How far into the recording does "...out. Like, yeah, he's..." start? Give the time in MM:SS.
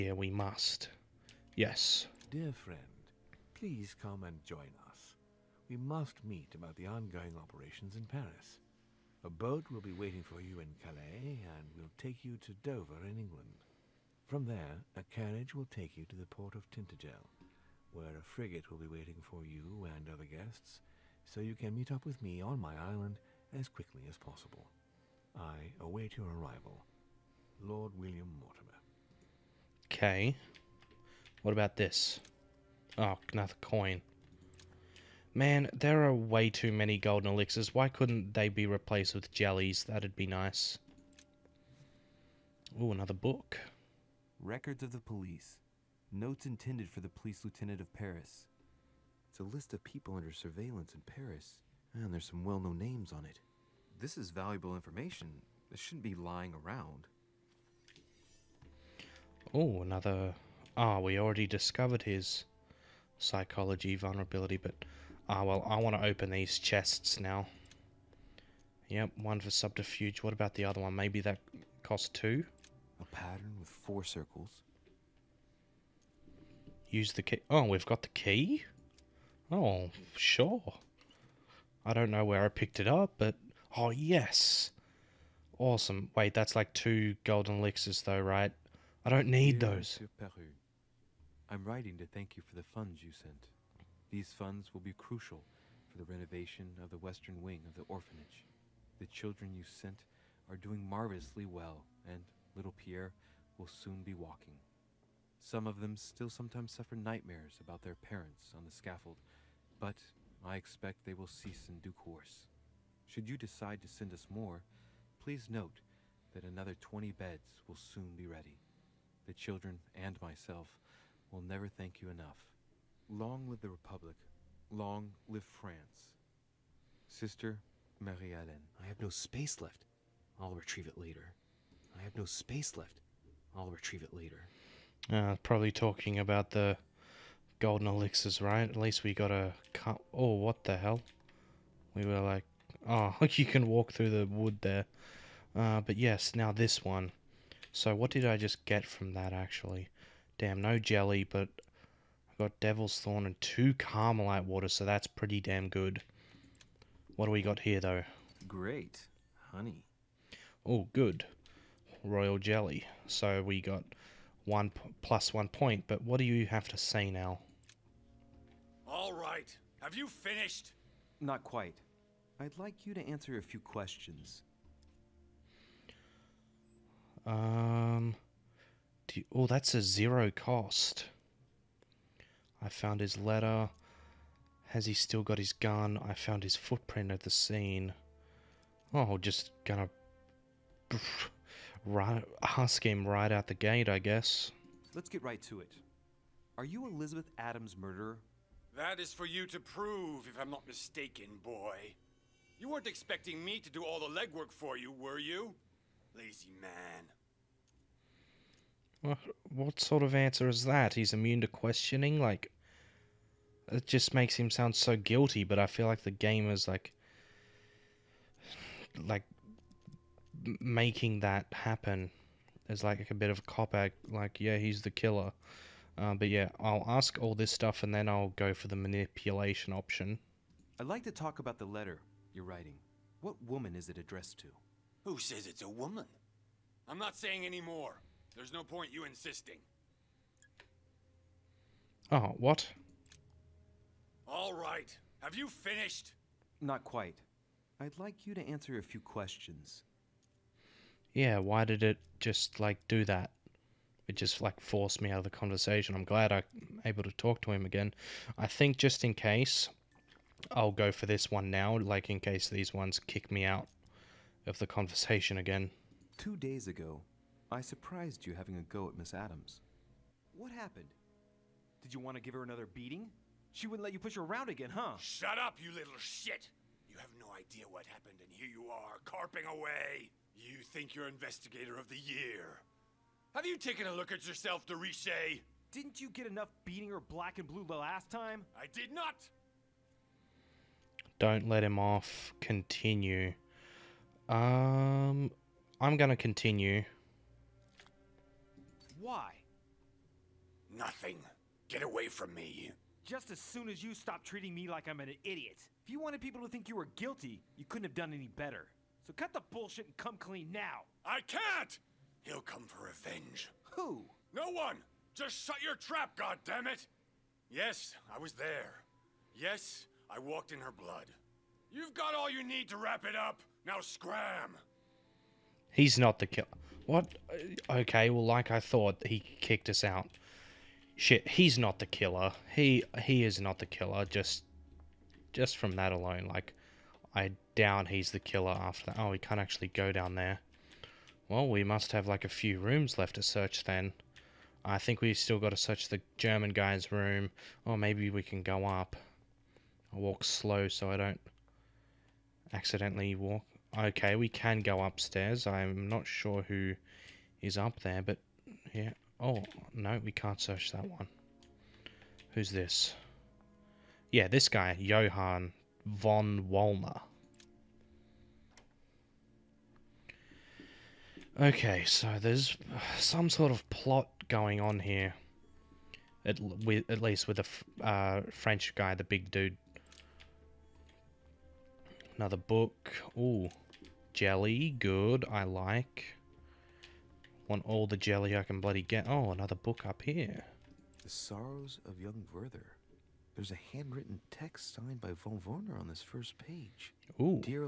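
03:43.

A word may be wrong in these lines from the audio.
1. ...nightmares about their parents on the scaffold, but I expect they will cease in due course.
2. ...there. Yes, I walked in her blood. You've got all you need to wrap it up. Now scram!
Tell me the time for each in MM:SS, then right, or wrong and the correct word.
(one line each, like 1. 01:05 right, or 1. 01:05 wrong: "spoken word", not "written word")
1. 01:46 right
2. 05:18 right.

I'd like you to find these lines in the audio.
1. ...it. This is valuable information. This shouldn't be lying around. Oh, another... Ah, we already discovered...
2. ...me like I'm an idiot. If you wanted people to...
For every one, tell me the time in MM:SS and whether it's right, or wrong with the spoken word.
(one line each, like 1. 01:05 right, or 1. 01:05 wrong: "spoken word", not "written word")
1. 00:53 right
2. 05:04 right.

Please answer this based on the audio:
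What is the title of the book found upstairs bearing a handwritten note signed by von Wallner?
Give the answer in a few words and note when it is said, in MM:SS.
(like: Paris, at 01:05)
The Sorrows of Young Werther, at 06:31.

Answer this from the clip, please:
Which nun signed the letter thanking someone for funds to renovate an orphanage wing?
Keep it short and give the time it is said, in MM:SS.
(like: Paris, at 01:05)
Sister Marie-Hélène, at 02:07.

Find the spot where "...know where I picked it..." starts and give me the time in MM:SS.
01:22.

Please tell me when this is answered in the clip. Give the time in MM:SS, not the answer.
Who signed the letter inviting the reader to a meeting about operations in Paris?
00:27.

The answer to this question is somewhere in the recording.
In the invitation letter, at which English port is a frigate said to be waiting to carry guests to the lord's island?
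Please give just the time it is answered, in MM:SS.
00:16.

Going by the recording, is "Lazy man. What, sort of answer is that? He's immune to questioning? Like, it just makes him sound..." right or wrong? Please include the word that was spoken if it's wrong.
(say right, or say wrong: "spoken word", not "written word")
right.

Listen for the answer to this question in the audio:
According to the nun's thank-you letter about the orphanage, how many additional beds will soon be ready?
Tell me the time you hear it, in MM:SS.
01:56.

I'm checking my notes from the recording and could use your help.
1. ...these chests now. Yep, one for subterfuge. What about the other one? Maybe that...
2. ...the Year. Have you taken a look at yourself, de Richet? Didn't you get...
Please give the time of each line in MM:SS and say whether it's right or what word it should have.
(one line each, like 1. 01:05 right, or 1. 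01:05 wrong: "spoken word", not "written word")
1. 01:06 right
2. 04:41 right.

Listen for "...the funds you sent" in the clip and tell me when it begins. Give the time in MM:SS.
01:32.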